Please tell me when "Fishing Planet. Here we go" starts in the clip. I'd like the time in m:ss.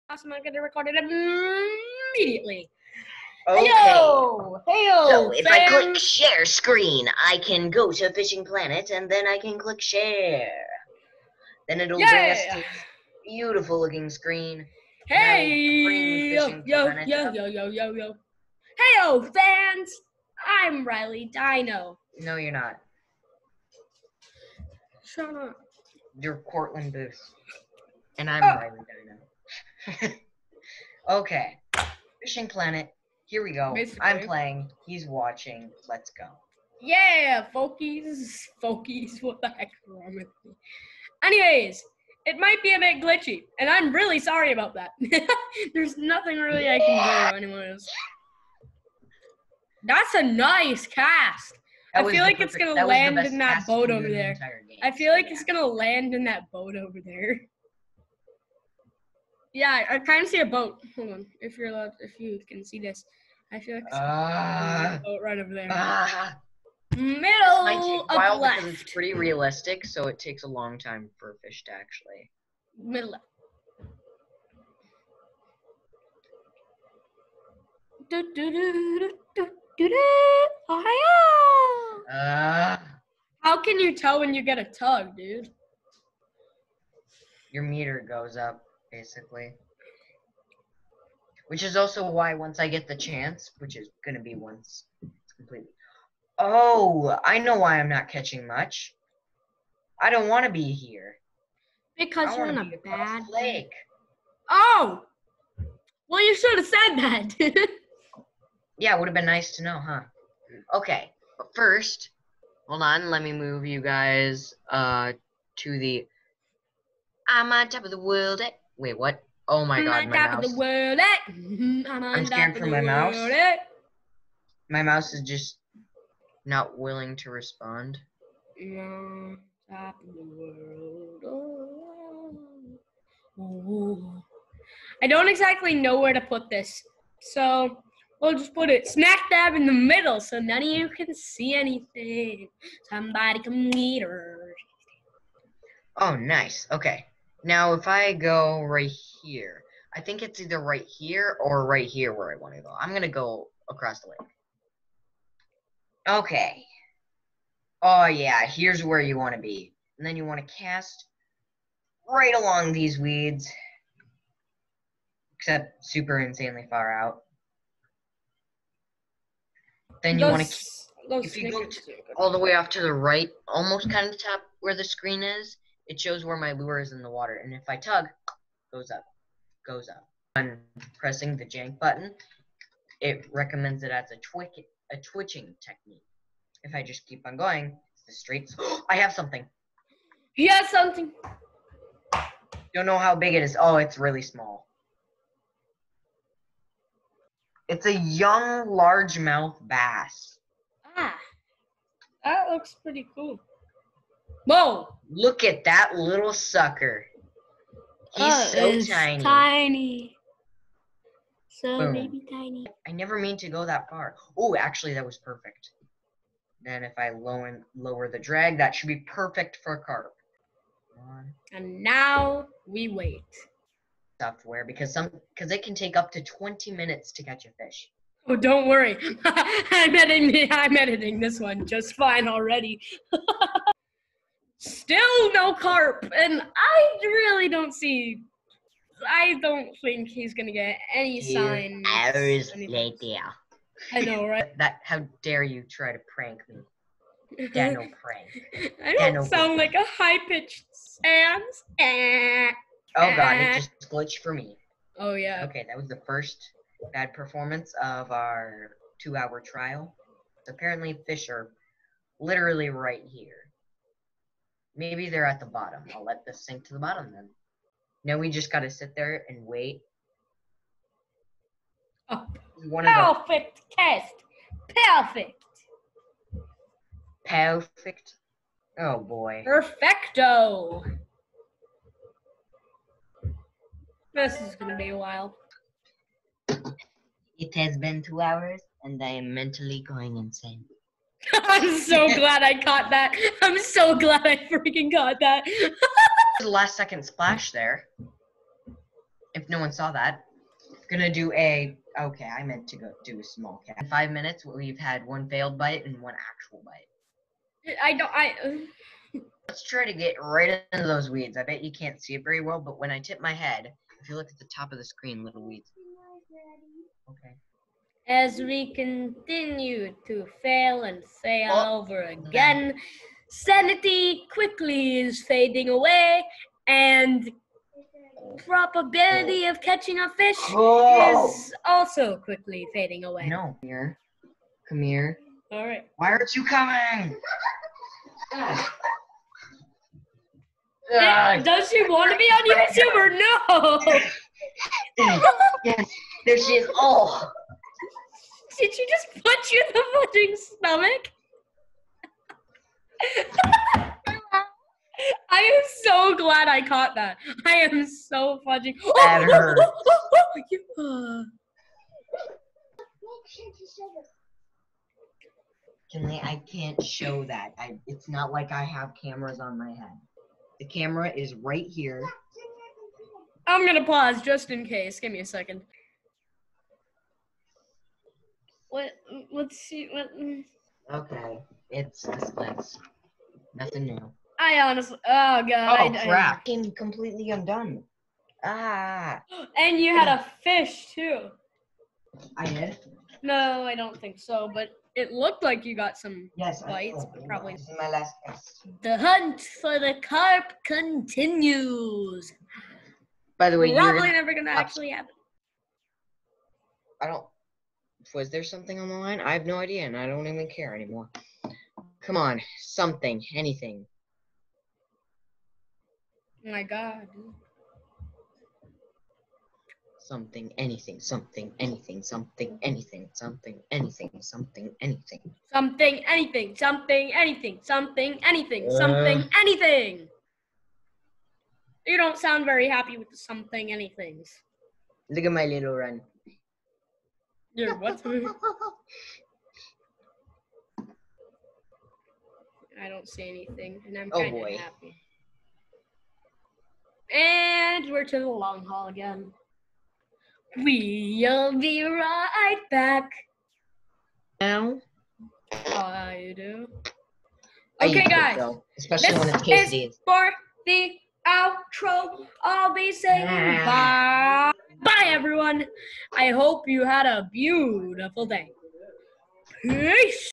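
0:32.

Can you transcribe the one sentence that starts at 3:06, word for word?
If I just keep on going, it's the streets.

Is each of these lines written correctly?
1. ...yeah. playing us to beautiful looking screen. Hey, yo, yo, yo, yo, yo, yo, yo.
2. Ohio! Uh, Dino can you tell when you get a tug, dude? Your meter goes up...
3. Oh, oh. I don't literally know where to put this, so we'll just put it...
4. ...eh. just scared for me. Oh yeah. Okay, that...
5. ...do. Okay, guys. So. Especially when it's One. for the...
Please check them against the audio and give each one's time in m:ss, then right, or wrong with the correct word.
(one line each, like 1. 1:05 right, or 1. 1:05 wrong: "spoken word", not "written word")
1. 0:11 wrong: "bring", not "playing"
2. 1:20 wrong: "How", not "Dino"
3. 2:08 wrong: "exactly", not "literally"
4. 4:13 wrong: "glitched", not "scared"
5. 7:36 wrong: "Casey", not "One".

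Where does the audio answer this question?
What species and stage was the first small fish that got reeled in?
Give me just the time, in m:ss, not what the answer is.
3:17.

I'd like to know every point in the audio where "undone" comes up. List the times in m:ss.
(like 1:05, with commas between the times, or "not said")
6:27.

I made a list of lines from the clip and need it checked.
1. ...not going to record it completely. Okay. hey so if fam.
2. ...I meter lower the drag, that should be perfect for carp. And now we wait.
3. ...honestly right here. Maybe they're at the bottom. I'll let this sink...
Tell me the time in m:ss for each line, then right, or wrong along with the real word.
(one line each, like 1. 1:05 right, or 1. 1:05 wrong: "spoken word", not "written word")
1. 0:00 wrong: "immediately", not "completely"
2. 3:36 wrong: "lower", not "meter"
3. 4:22 wrong: "literally", not "honestly".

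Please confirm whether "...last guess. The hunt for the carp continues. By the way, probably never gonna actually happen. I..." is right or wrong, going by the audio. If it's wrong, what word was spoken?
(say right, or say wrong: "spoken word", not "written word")
right.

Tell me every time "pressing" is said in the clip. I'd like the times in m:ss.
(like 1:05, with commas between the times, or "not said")
3:00.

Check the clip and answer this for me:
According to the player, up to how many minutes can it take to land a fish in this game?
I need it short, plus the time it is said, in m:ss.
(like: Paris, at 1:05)
20, at 3:46.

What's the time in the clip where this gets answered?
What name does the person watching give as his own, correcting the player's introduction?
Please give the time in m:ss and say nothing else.
0:26.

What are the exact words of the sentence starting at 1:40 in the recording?
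I don't want to be here.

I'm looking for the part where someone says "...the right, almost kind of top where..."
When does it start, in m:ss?
2:52.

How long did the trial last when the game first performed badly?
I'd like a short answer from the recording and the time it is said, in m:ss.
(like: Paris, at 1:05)
two hours, at 4:19.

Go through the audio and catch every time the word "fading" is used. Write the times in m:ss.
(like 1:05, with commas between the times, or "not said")
5:25, 5:32.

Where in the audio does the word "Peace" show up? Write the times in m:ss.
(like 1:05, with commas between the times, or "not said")
7:49.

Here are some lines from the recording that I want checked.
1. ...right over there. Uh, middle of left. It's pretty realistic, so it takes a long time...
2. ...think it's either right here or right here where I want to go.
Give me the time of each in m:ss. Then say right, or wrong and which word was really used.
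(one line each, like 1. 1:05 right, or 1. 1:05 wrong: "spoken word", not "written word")
1. 1:05 right
2. 2:30 right.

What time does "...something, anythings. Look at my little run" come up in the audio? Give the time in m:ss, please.
7:13.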